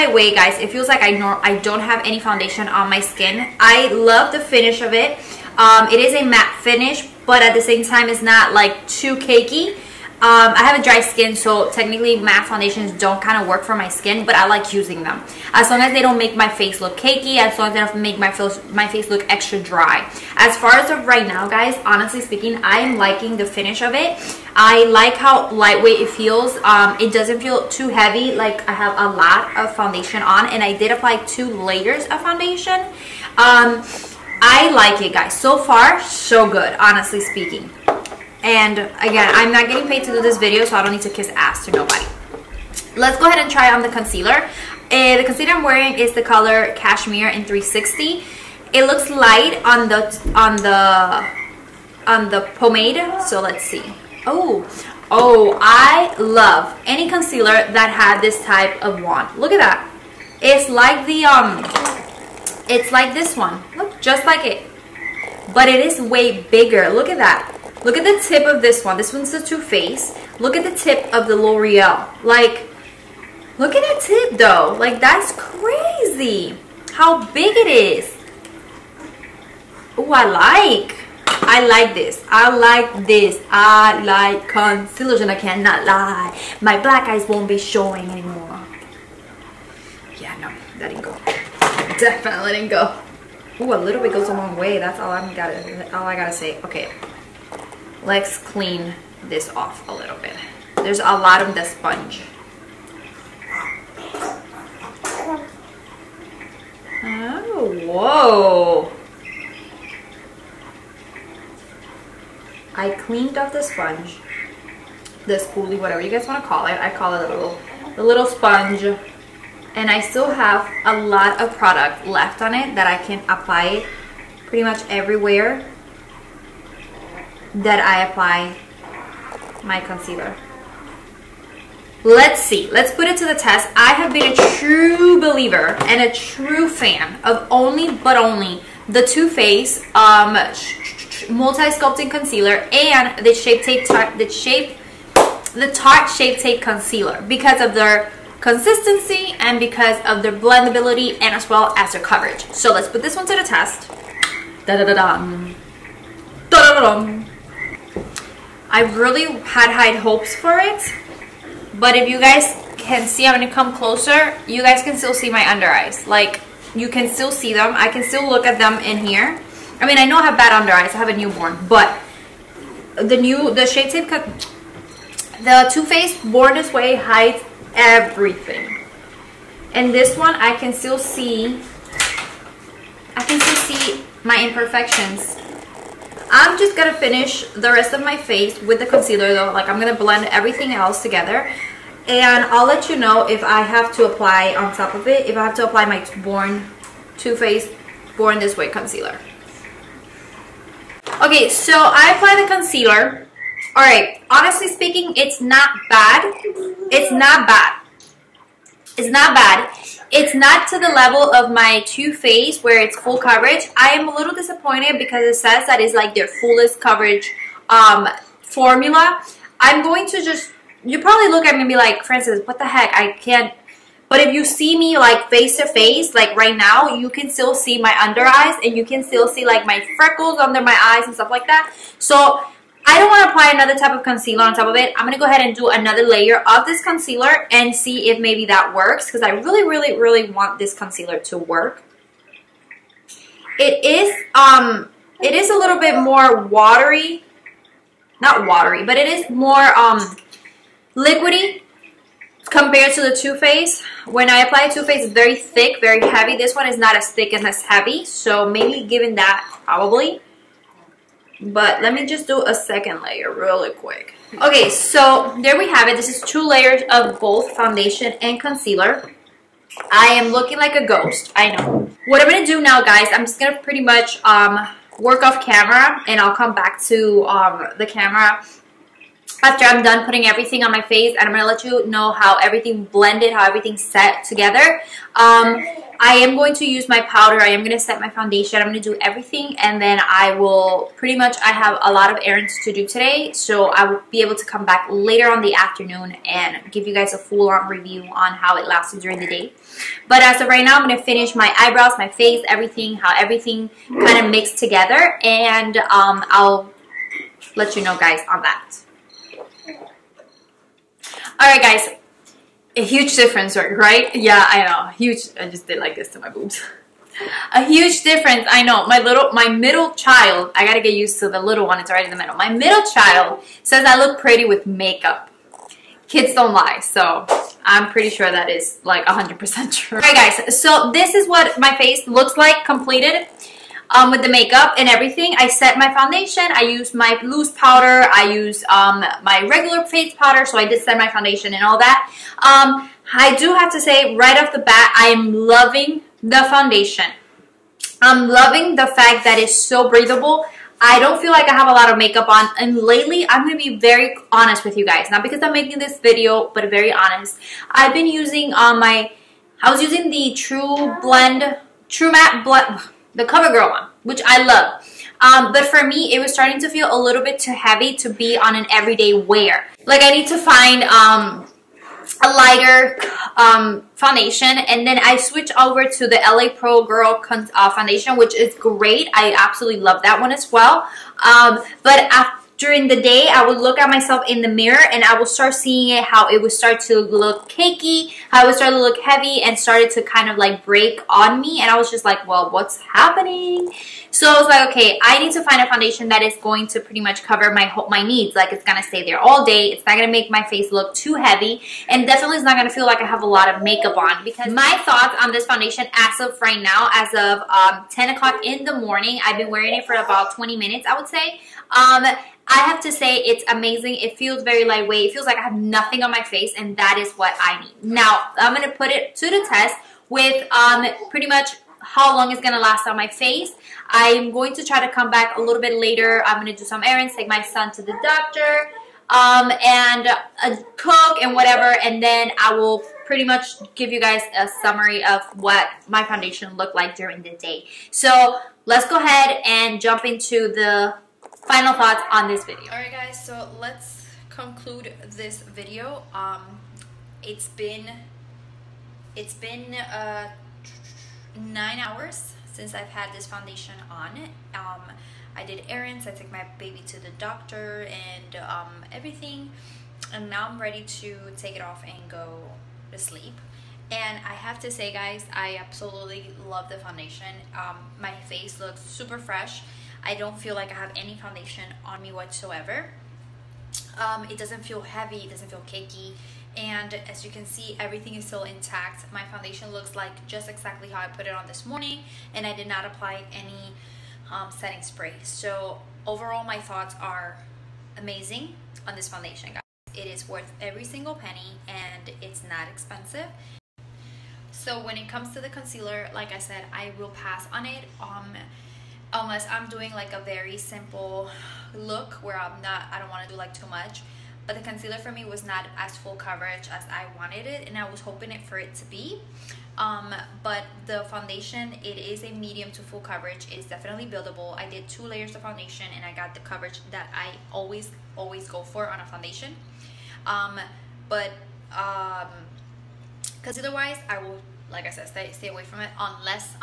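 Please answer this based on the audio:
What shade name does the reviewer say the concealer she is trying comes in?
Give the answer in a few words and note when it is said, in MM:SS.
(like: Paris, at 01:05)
Cashmere, at 00:46.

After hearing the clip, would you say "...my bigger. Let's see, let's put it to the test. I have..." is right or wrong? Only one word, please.
wrong.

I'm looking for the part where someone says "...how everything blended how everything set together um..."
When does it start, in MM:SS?
04:42.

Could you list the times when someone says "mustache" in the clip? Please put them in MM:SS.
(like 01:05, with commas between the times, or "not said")
not said.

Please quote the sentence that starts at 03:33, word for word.
I am a little disappointed because it says that it's like their fullest coverage um, formula.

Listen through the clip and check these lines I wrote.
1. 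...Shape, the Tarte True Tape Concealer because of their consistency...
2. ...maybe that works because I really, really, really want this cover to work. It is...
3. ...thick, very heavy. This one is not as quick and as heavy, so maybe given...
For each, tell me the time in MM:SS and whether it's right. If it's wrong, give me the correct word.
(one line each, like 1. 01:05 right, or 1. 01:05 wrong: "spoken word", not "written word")
1. 02:24 wrong: "Shape", not "True"
2. 03:58 wrong: "concealer", not "cover"
3. 04:15 wrong: "thick", not "quick".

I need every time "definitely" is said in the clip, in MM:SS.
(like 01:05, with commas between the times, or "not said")
01:31, 06:42, 08:33.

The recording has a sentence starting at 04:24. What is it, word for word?
Okay, so there we have it.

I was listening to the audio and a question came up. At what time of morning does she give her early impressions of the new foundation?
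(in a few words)
10 o'clock.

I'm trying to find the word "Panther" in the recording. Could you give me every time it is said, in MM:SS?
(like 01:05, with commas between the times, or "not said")
not said.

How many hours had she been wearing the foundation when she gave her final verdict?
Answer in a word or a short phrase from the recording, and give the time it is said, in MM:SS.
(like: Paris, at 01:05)
9, at 07:31.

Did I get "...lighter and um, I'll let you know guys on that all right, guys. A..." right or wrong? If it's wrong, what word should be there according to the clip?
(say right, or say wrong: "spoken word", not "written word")
wrong: "together", not "lighter".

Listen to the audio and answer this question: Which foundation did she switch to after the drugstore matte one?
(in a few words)
LA Pro Glow.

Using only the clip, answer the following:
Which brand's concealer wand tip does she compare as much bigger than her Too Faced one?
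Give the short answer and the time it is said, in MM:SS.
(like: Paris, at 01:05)
L'Oreal, at 01:11.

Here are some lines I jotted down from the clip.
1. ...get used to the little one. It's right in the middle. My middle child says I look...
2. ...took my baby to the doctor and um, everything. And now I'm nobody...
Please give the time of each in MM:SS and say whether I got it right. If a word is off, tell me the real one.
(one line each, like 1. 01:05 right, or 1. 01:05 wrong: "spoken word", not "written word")
1. 05:20 right
2. 07:36 wrong: "ready", not "nobody".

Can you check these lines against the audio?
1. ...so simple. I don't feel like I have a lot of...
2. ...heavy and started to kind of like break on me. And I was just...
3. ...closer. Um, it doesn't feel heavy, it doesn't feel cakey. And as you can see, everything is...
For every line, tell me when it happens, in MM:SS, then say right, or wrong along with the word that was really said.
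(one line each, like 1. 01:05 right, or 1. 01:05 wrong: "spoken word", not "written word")
1. 05:49 wrong: "breathable", not "simple"
2. 06:28 right
3. 07:52 wrong: "whatsoever", not "closer".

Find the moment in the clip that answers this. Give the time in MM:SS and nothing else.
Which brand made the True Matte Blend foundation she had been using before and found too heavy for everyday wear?
06:03.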